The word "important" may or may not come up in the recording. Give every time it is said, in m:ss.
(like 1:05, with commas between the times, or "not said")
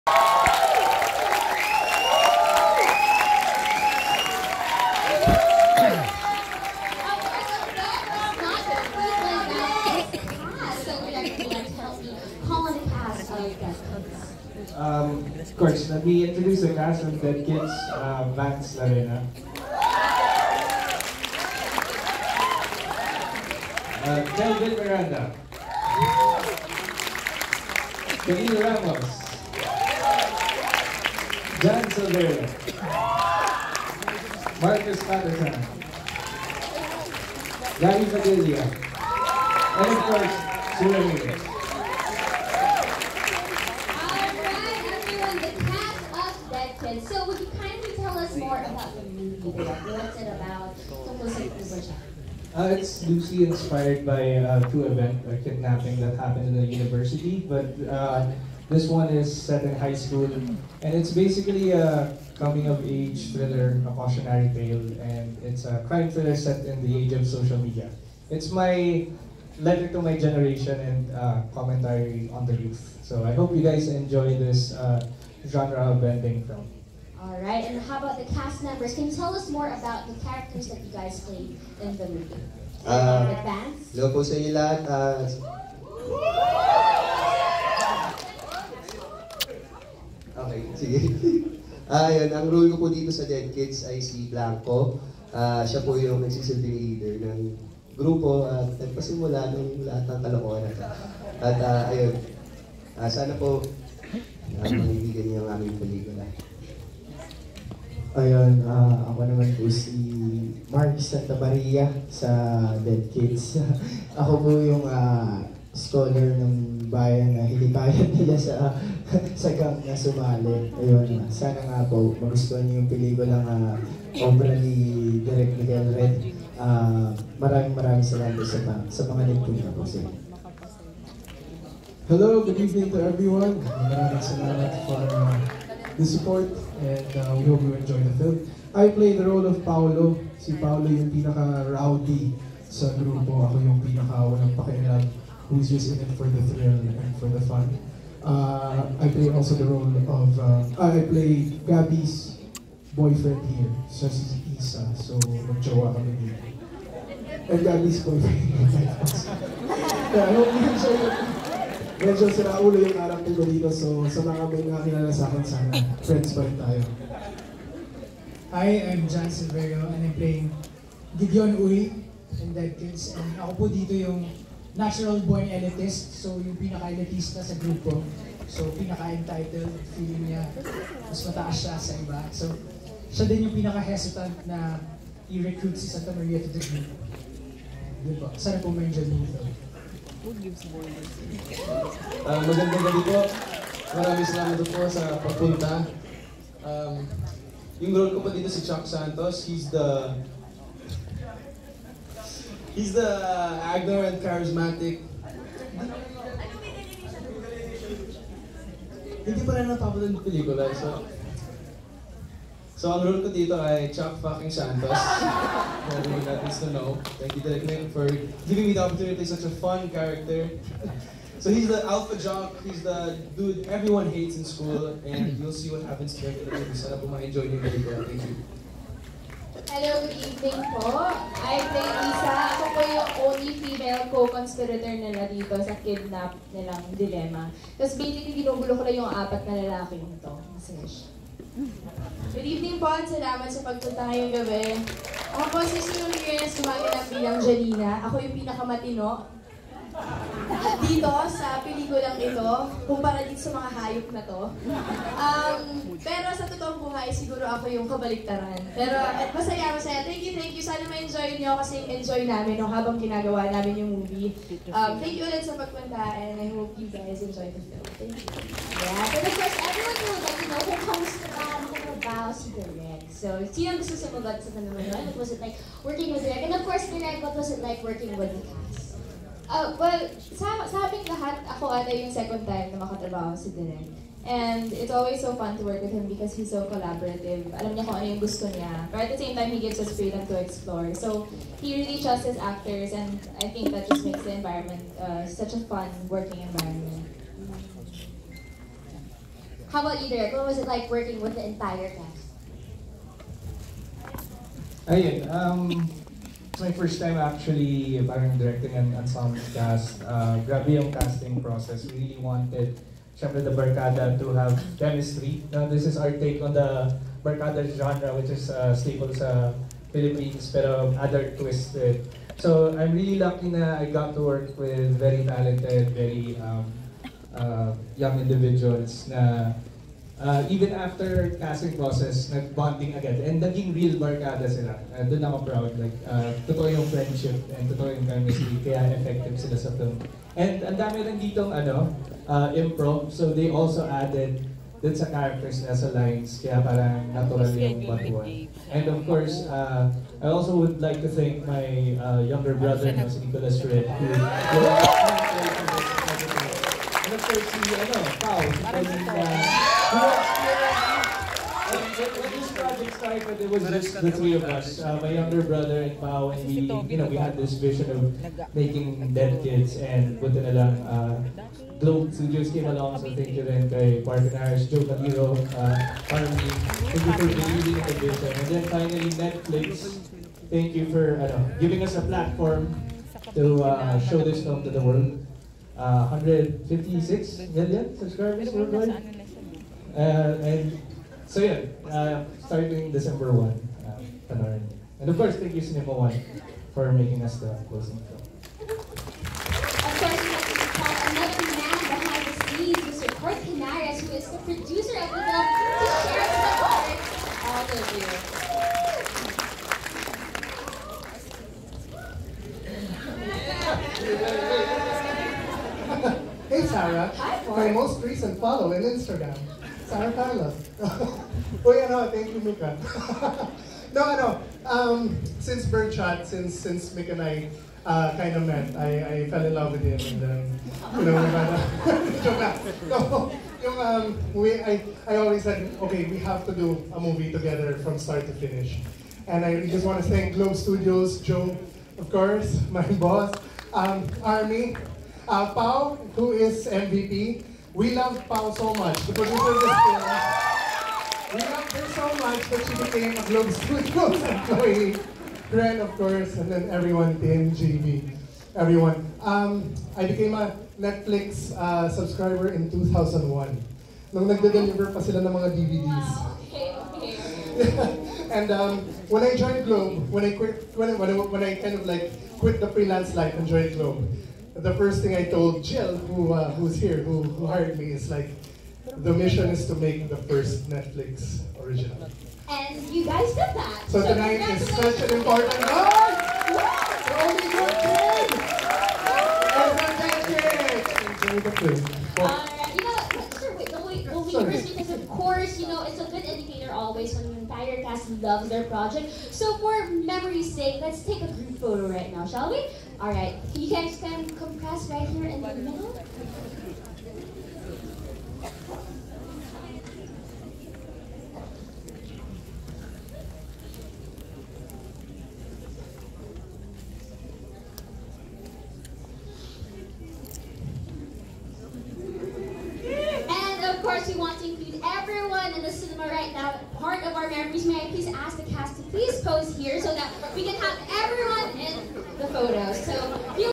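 8:05.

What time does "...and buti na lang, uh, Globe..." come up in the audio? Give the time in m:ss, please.
6:09.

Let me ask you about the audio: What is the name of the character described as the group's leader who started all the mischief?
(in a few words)
Blanco.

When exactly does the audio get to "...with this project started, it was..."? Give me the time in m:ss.
5:59.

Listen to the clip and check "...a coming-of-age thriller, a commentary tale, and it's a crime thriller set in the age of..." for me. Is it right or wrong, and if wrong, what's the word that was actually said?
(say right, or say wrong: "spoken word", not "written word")
wrong: "cautionary", not "commentary".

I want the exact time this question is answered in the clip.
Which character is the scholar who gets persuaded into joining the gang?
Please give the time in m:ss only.
1:50.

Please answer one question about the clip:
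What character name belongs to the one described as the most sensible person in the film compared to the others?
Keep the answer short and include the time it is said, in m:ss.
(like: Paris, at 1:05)
Janina, at 4:07.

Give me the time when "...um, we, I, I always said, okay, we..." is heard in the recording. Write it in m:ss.
7:13.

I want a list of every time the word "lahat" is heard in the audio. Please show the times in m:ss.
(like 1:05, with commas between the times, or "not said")
1:24, 1:39, 4:41.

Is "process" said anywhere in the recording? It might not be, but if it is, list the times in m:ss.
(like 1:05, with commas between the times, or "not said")
5:11, 5:31.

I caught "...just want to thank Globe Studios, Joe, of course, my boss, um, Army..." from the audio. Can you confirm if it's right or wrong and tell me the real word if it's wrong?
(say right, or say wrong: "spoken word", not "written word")
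right.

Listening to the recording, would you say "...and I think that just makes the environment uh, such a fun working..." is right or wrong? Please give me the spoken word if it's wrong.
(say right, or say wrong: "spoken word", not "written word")
right.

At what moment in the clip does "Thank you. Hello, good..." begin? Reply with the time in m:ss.
3:48.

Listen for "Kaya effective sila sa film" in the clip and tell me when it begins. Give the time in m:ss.
5:38.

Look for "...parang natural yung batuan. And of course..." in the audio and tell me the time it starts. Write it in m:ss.
5:46.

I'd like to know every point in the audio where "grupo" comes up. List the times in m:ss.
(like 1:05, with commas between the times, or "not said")
1:38, 2:22, 2:57.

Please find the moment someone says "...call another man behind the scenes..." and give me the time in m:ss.
6:40.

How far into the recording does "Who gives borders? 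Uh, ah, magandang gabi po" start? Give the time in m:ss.
3:10.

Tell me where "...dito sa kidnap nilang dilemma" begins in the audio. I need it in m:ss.
3:55.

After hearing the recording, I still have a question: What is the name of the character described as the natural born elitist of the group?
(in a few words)
Gideon Uri.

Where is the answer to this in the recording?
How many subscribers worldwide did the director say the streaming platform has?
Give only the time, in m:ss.
6:26.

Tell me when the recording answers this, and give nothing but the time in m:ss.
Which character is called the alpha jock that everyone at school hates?
3:18.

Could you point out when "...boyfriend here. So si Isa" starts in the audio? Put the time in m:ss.
2:32.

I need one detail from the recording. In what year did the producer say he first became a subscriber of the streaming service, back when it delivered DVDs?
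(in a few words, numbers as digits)
2001.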